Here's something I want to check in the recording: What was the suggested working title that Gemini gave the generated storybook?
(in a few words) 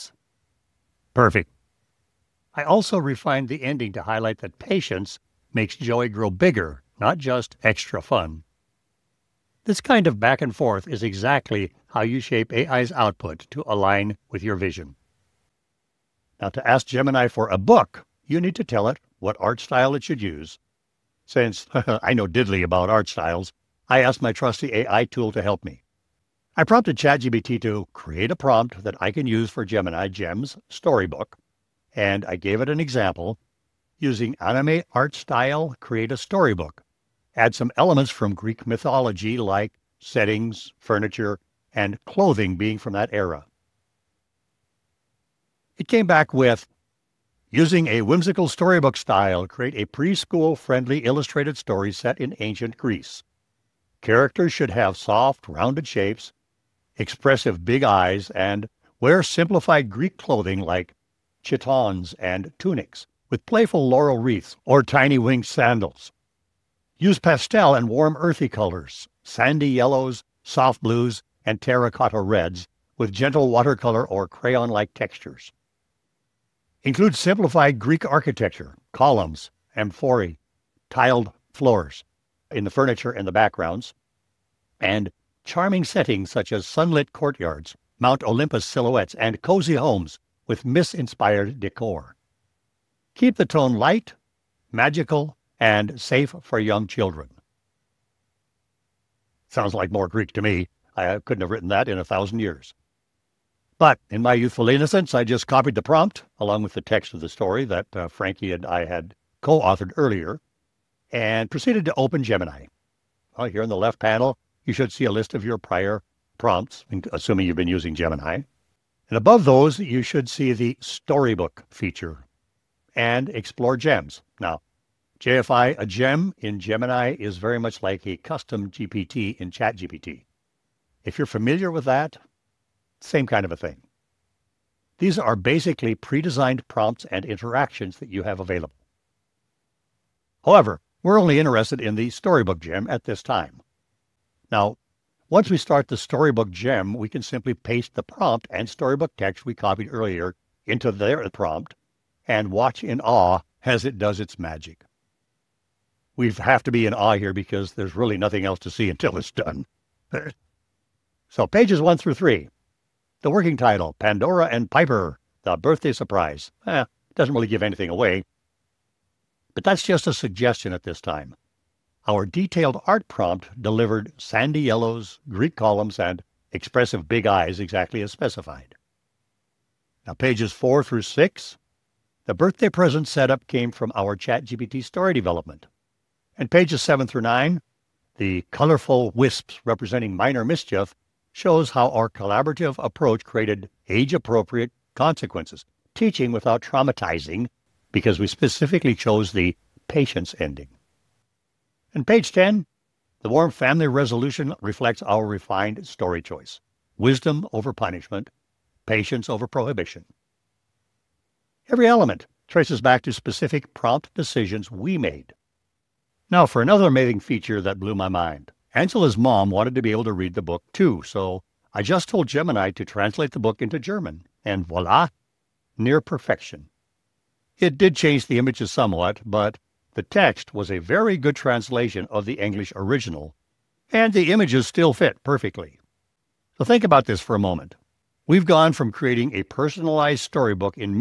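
Pandora and Piper, The Birthday Surprise.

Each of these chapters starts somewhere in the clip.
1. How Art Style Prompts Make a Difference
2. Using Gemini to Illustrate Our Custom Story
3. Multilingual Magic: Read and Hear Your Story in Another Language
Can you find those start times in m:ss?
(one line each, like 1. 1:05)
1. 0:15
2. 1:42
3. 3:34.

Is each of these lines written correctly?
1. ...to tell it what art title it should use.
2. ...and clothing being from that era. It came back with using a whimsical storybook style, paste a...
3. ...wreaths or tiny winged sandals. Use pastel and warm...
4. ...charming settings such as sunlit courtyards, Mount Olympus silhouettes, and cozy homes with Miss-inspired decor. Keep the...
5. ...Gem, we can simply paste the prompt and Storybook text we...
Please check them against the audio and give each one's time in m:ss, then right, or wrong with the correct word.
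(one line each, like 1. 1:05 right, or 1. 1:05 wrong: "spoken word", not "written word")
1. 0:18 wrong: "style", not "title"
2. 0:41 wrong: "create", not "paste"
3. 1:04 right
4. 1:25 right
5. 2:26 right.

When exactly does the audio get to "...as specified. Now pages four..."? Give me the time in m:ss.
2:58.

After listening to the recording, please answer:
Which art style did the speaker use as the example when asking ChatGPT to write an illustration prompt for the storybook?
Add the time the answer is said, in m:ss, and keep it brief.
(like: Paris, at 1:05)
Anime, at 0:34.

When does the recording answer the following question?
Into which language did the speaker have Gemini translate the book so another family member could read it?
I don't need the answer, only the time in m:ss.
3:43.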